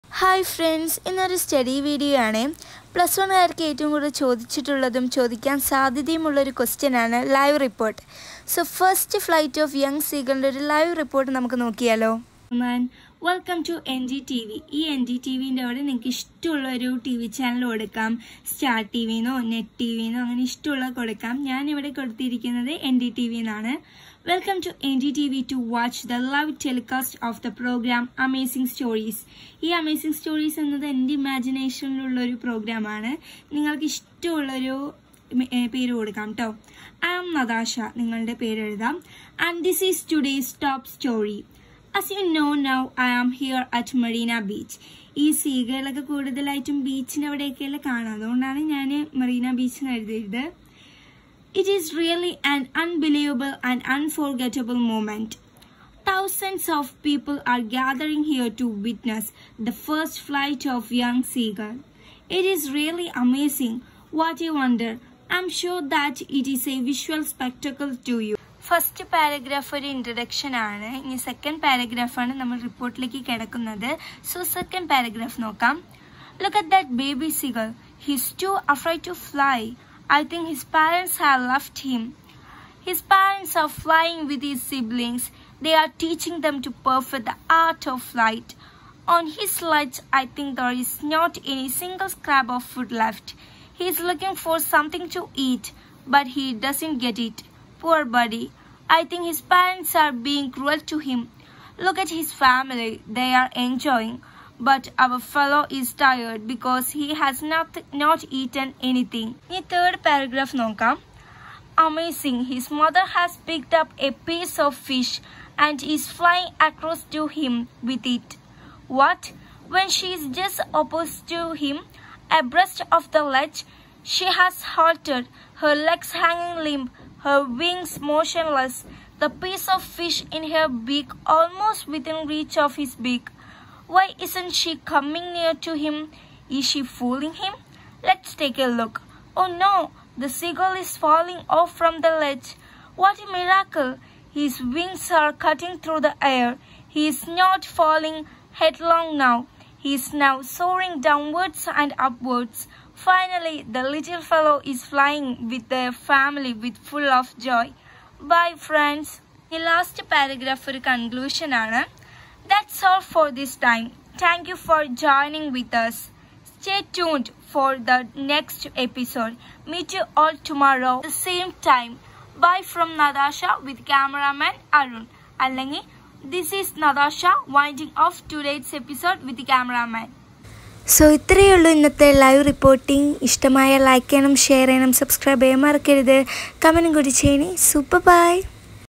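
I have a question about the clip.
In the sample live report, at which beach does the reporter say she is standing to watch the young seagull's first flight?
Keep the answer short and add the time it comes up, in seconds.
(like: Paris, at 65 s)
Marina Beach, at 44 s.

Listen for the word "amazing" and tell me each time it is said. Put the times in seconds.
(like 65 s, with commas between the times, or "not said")
63 s, 111 s.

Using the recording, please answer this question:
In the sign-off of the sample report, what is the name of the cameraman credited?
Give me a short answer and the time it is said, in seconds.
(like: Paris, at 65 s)
Arun, at 174 s.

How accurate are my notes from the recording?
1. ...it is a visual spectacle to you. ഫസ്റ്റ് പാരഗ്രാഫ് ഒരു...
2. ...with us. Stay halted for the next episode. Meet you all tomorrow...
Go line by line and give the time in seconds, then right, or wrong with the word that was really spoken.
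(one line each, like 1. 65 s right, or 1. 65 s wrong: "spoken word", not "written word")
1. 66 s right
2. 165 s wrong: "tuned", not "halted".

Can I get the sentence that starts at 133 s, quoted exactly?
Why isn't she coming near to him?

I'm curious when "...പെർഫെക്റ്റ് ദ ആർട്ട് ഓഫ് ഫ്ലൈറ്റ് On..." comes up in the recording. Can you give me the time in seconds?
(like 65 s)
86 s.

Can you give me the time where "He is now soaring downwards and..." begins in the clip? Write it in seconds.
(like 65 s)
149 s.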